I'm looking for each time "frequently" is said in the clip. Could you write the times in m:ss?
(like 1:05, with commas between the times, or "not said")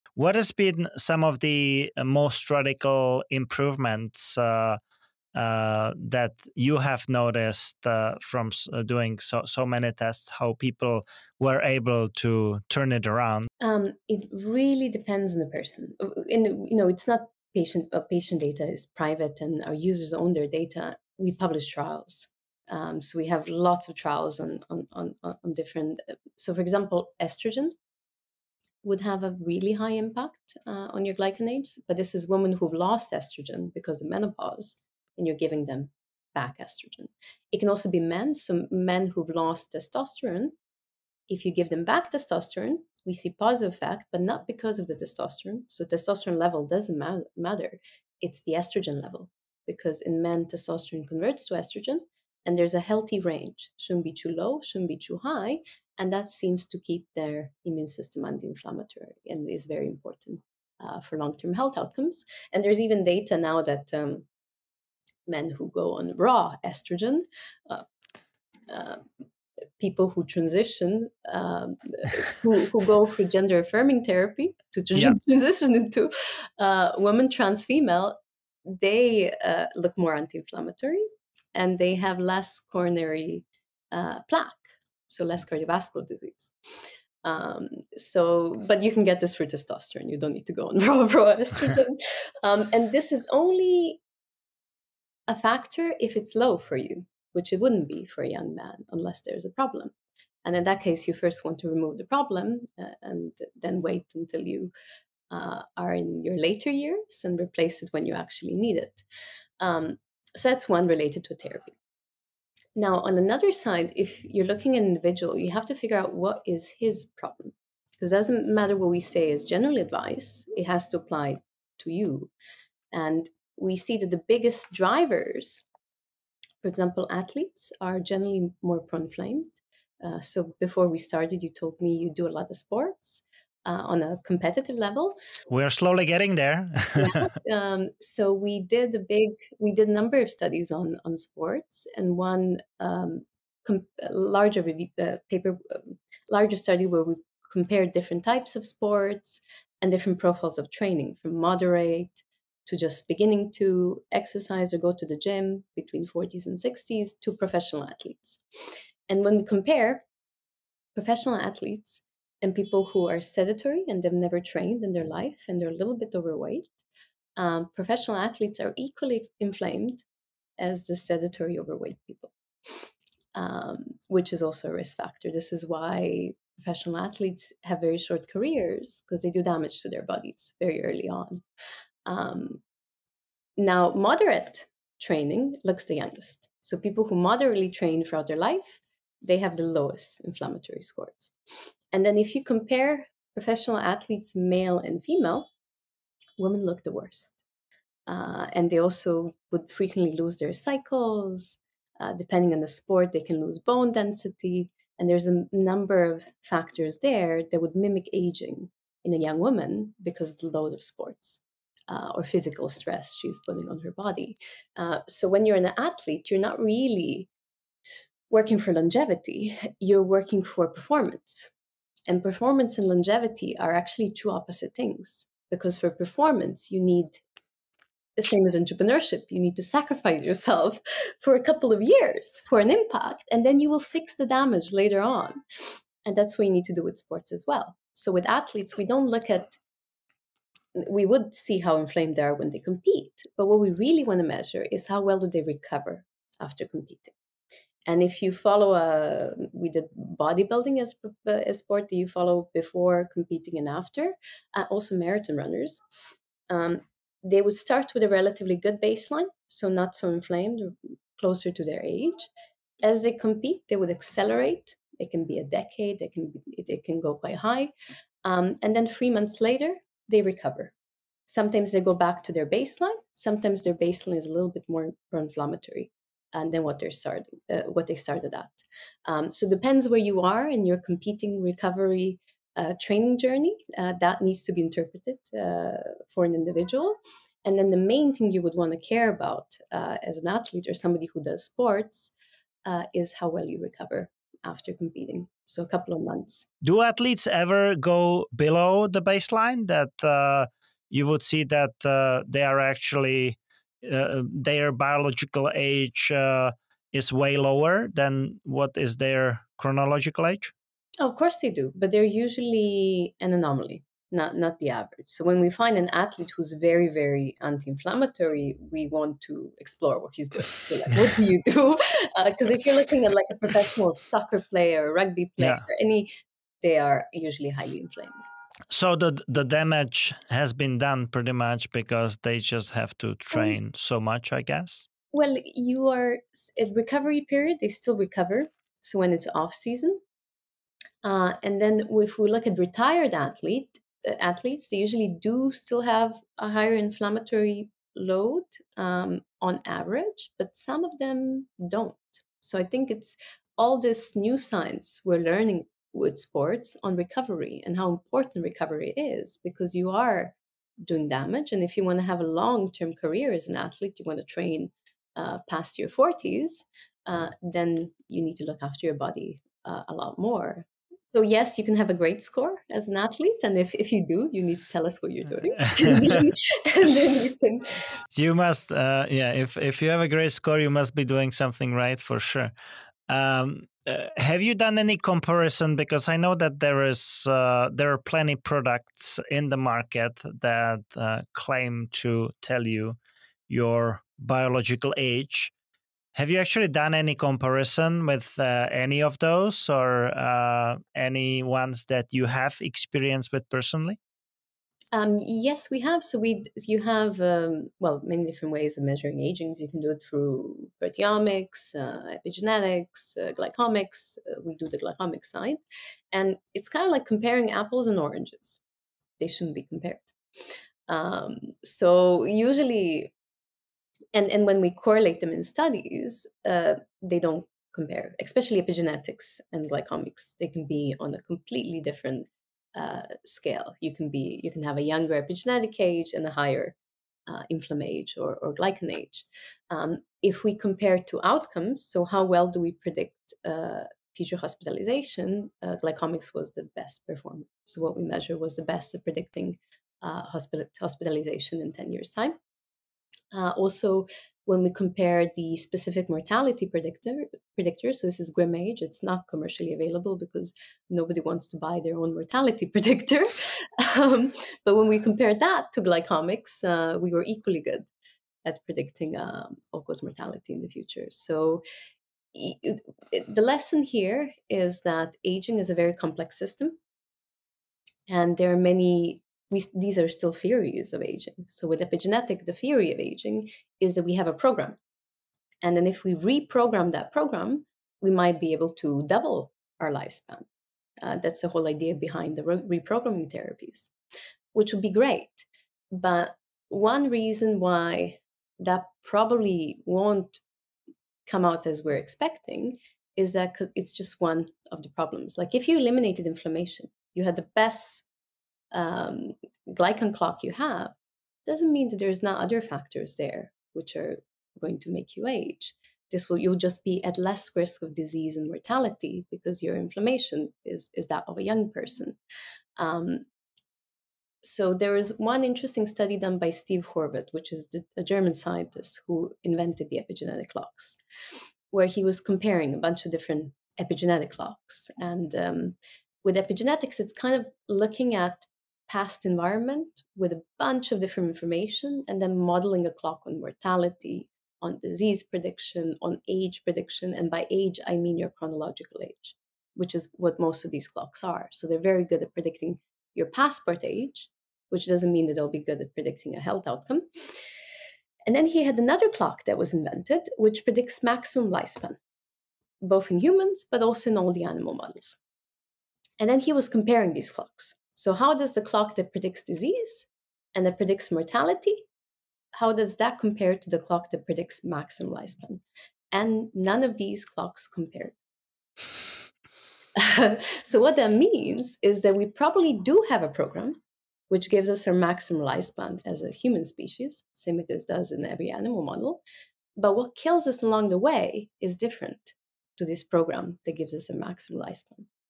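3:19.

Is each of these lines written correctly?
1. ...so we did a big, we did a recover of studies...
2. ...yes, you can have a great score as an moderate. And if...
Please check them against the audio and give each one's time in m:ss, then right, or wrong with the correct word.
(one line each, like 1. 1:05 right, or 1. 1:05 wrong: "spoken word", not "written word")
1. 2:17 wrong: "number", not "recover"
2. 6:11 wrong: "athlete", not "moderate".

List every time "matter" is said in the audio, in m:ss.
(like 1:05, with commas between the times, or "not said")
0:47, 1:58.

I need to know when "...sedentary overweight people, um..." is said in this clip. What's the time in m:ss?
2:50.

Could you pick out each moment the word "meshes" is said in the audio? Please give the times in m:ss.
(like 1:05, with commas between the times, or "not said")
not said.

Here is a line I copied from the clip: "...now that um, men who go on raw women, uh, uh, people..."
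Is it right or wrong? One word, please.
wrong.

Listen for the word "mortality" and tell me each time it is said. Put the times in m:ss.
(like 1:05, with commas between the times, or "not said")
7:36, 7:42, 7:50, 8:38, 9:03, 9:31.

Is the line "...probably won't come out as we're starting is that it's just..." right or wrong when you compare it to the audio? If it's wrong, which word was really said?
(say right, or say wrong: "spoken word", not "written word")
wrong: "expecting", not "starting".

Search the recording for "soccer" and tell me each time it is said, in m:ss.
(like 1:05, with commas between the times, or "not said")
5:23.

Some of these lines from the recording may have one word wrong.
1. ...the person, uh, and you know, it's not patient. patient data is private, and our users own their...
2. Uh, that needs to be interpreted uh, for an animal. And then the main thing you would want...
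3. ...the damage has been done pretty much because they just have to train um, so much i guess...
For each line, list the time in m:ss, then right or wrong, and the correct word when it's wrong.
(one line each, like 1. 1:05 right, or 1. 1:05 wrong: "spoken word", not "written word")
1. 0:15 right
2. 4:43 wrong: "individual", not "animal"
3. 5:29 right.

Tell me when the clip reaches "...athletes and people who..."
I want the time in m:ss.
2:41.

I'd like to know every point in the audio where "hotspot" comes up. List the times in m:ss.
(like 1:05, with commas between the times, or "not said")
not said.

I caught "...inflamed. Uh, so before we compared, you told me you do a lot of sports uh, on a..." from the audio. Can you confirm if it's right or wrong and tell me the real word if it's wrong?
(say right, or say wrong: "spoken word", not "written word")
wrong: "started", not "compared".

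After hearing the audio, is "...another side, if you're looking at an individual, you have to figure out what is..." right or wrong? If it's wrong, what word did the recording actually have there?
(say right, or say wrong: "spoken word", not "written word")
right.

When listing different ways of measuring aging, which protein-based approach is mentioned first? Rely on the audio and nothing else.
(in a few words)
Proteomics.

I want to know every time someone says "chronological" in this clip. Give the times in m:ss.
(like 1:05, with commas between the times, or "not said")
5:09, 9:08.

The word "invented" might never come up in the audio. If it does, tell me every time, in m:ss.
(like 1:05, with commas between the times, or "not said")
8:49, 9:19.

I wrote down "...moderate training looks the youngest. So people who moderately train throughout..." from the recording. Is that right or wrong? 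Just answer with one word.
right.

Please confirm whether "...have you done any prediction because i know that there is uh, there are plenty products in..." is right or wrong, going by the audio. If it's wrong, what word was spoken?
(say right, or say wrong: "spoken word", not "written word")
wrong: "comparison", not "prediction".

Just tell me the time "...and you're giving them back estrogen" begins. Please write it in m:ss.
0:35.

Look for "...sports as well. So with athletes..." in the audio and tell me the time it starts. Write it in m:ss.
3:56.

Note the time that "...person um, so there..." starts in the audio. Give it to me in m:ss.
8:41.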